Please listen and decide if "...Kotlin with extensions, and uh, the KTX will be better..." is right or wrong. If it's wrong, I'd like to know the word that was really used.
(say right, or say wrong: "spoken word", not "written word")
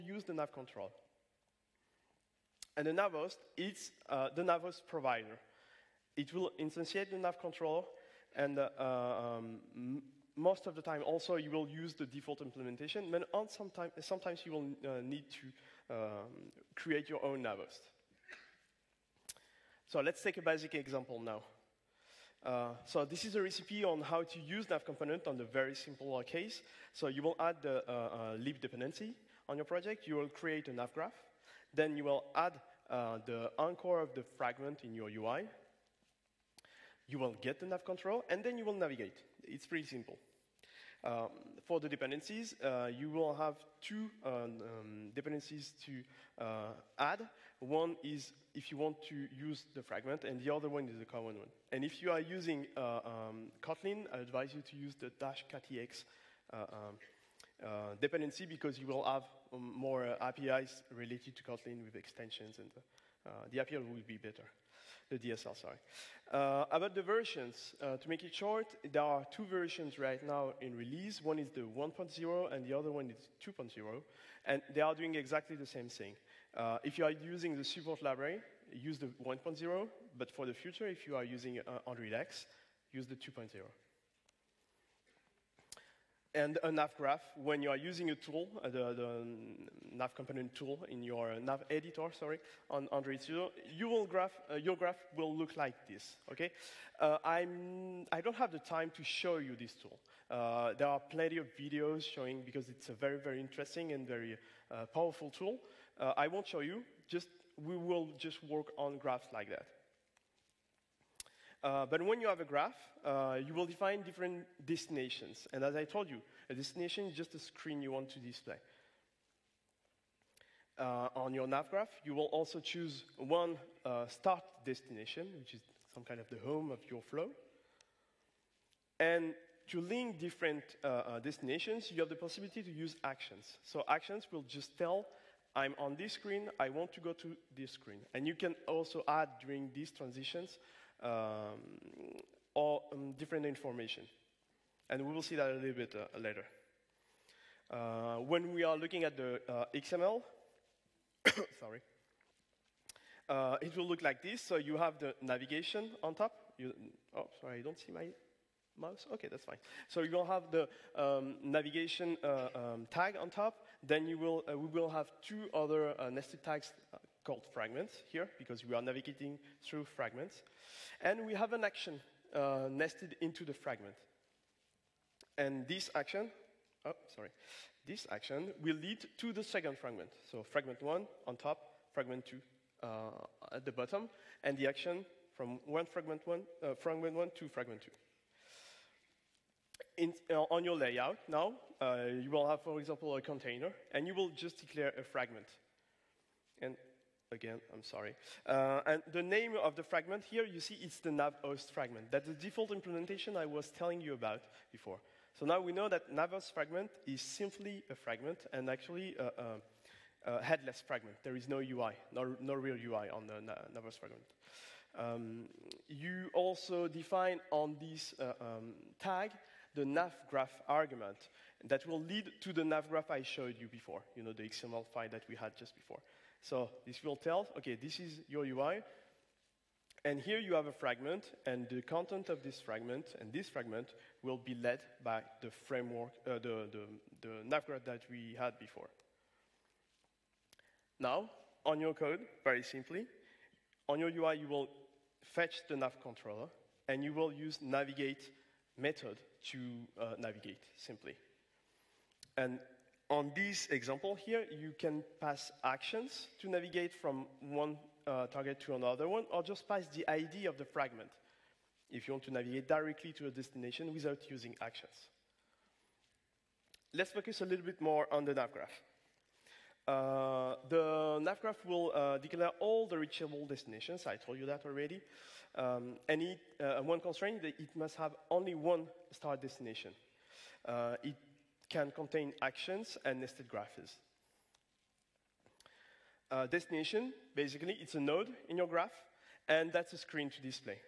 wrong: "API", not "KTX".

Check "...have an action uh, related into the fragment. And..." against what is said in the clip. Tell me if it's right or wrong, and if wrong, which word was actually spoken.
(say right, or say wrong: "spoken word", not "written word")
wrong: "nested", not "related".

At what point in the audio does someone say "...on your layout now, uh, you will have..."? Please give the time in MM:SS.
03:10.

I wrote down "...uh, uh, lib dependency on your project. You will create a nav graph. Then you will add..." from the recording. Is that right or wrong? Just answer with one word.
right.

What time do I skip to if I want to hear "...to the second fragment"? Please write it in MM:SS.
02:59.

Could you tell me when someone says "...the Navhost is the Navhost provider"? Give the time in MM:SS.
00:02.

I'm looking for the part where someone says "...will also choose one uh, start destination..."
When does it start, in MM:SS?
02:02.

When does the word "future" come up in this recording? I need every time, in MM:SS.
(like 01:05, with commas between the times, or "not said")
01:20.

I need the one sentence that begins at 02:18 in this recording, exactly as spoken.
And you can also add during these transitions um, or um, different information.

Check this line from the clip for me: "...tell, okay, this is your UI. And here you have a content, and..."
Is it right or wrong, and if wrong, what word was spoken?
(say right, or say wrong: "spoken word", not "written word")
wrong: "fragment", not "content".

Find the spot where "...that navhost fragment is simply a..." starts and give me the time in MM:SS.
03:25.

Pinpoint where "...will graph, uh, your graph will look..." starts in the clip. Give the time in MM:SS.
01:33.